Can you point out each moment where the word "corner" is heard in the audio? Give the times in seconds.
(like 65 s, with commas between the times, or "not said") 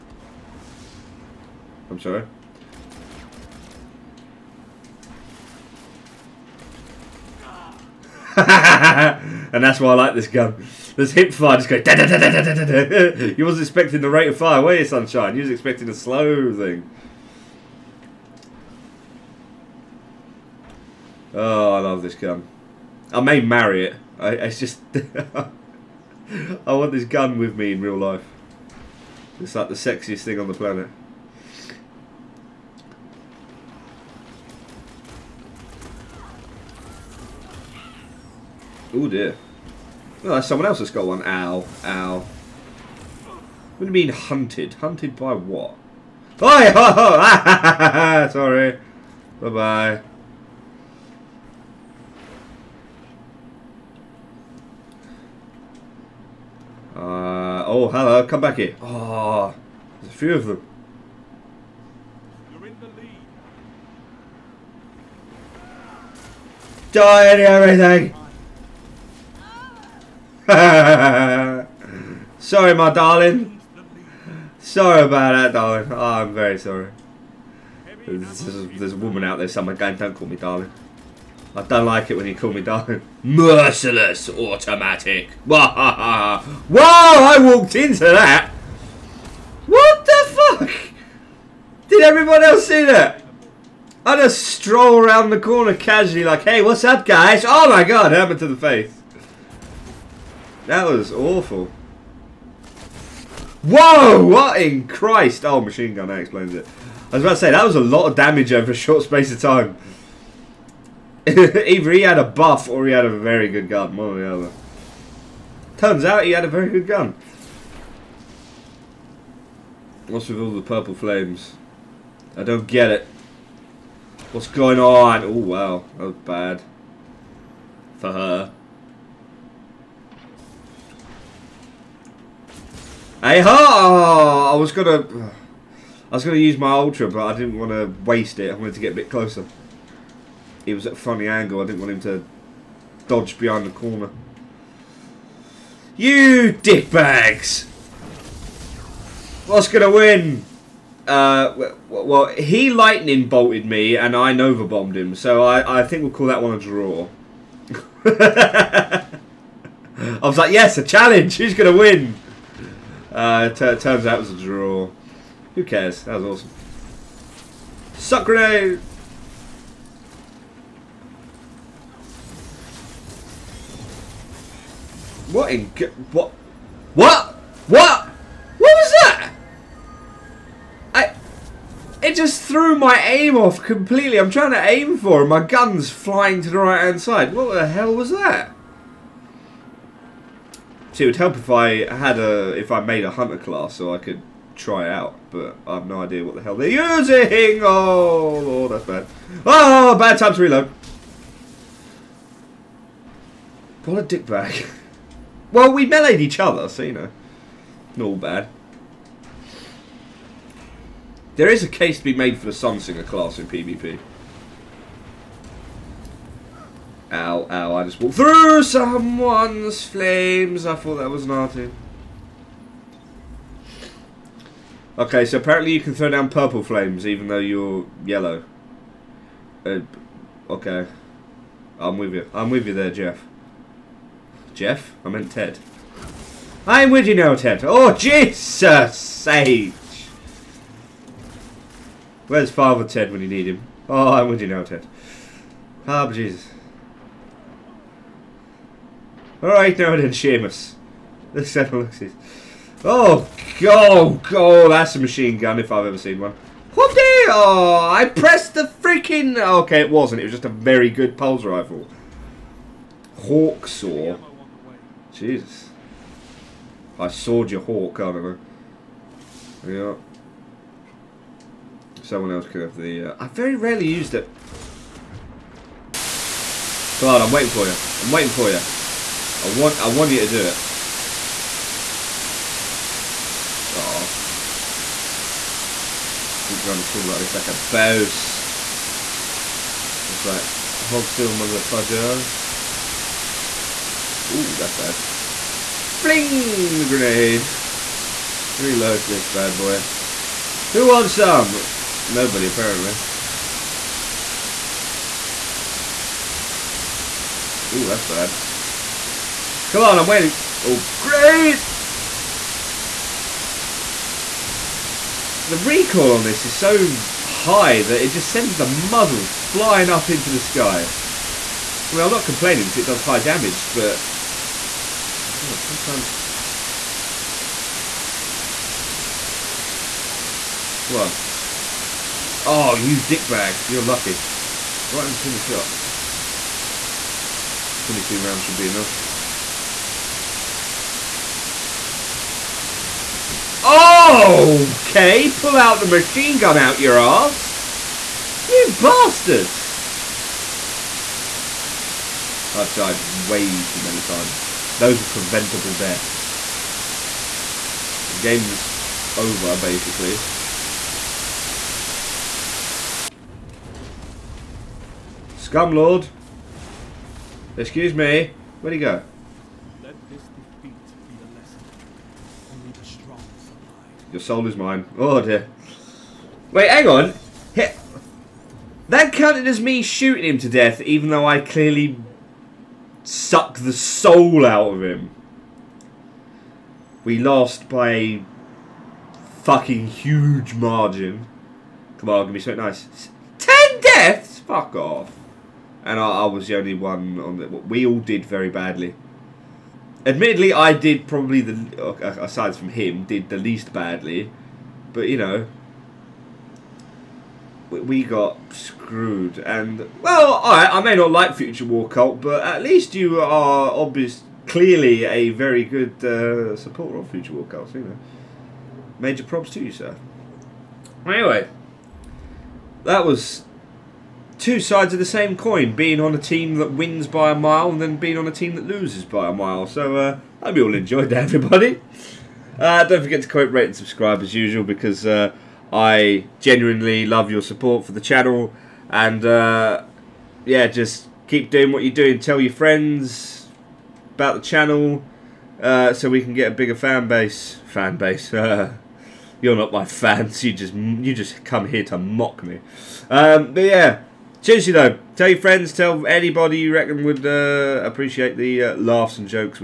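95 s, 143 s, 286 s.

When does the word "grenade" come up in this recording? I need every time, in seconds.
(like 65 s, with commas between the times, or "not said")
168 s, 296 s.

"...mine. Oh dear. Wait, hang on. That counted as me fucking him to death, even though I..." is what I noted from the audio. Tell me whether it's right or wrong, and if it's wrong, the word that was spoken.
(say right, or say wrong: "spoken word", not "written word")
wrong: "shooting", not "fucking".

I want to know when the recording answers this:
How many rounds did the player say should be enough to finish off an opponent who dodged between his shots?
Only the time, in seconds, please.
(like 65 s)
337 s.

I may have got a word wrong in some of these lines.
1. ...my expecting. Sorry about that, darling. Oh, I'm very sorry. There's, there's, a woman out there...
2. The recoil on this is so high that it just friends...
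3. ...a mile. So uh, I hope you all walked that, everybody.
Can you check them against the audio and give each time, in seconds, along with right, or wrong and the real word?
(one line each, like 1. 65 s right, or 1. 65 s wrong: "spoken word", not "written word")
1. 72 s wrong: "darling", not "expecting"
2. 315 s wrong: "sends", not "friends"
3. 429 s wrong: "enjoyed", not "walked".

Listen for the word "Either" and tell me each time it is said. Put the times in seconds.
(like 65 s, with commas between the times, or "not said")
111 s.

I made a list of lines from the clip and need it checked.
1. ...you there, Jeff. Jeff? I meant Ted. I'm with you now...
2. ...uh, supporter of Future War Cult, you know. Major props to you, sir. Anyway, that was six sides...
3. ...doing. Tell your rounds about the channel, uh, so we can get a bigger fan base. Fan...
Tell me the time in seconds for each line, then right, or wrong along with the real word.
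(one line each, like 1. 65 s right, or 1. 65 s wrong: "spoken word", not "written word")
1. 232 s right
2. 416 s wrong: "two", not "six"
3. 441 s wrong: "friends", not "rounds".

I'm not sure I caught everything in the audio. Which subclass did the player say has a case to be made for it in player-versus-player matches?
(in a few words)
Sunsinger.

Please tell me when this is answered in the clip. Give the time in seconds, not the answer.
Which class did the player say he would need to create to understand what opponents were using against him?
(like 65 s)
193 s.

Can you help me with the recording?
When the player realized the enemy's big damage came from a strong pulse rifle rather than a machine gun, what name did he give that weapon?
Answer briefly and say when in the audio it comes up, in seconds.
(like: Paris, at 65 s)
Hawksaw, at 263 s.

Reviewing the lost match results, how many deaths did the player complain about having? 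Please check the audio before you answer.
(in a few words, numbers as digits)
10.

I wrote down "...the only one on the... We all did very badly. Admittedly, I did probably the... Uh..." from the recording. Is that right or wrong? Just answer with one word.
right.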